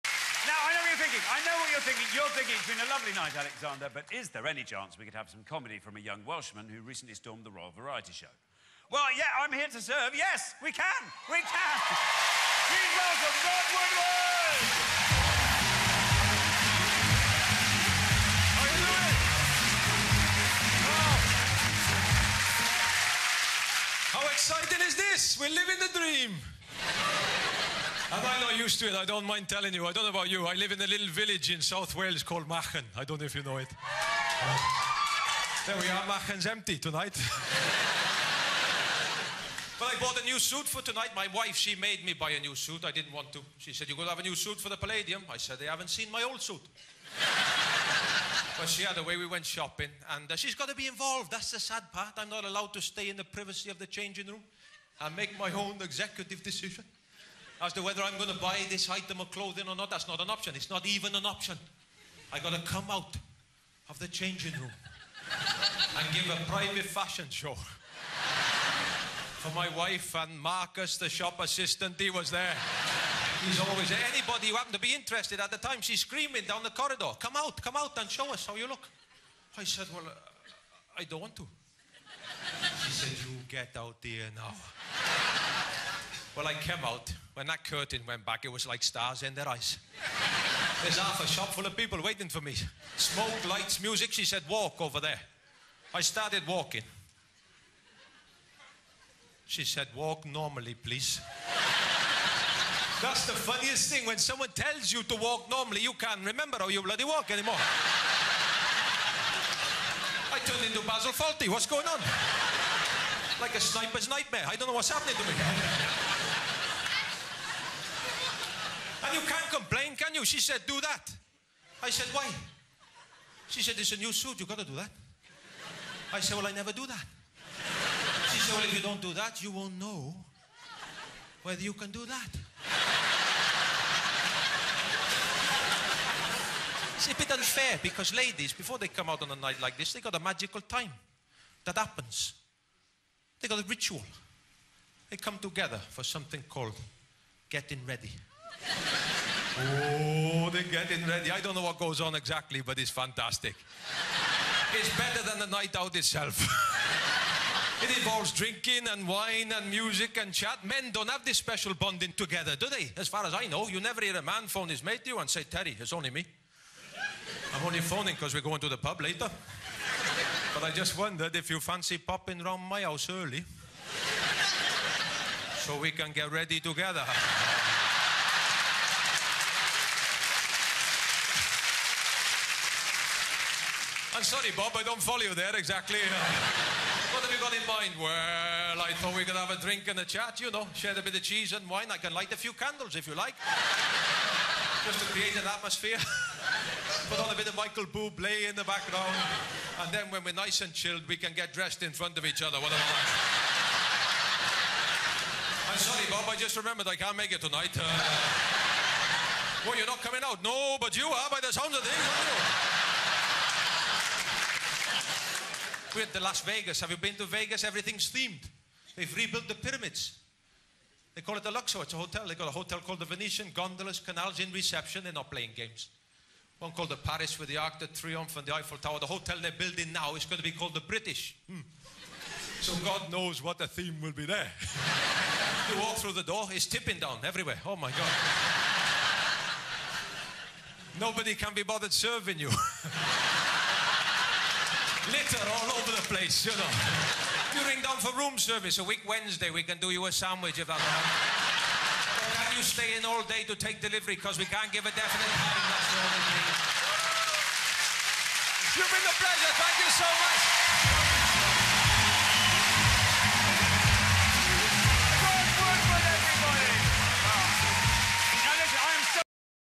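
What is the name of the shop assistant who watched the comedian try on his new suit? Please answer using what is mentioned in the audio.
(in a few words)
Marcus.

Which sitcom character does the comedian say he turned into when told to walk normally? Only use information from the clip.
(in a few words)
Basil Fawlty.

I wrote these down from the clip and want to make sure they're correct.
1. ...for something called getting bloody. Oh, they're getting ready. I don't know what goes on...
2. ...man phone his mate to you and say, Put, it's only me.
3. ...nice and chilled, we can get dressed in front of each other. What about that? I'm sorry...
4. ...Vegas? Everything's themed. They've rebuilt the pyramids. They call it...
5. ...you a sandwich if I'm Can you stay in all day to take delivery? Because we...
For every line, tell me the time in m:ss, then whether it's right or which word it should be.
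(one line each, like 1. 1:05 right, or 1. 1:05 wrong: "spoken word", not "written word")
1. 2:25 wrong: "ready", not "bloody"
2. 2:44 wrong: "Terry", not "Put"
3. 3:20 right
4. 3:37 right
5. 4:09 right.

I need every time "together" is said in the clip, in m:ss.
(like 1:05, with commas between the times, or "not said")
2:25, 2:42, 2:56.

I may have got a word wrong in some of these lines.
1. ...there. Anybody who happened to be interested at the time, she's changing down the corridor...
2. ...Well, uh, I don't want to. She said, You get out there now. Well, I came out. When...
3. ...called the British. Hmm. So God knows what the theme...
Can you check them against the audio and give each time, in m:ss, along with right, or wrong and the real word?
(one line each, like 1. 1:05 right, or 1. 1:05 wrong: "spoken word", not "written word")
1. 1:13 wrong: "screaming", not "changing"
2. 1:19 right
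3. 3:50 right.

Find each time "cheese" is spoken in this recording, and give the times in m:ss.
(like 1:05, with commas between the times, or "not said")
3:11.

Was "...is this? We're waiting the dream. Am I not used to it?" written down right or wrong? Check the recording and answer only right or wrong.
wrong.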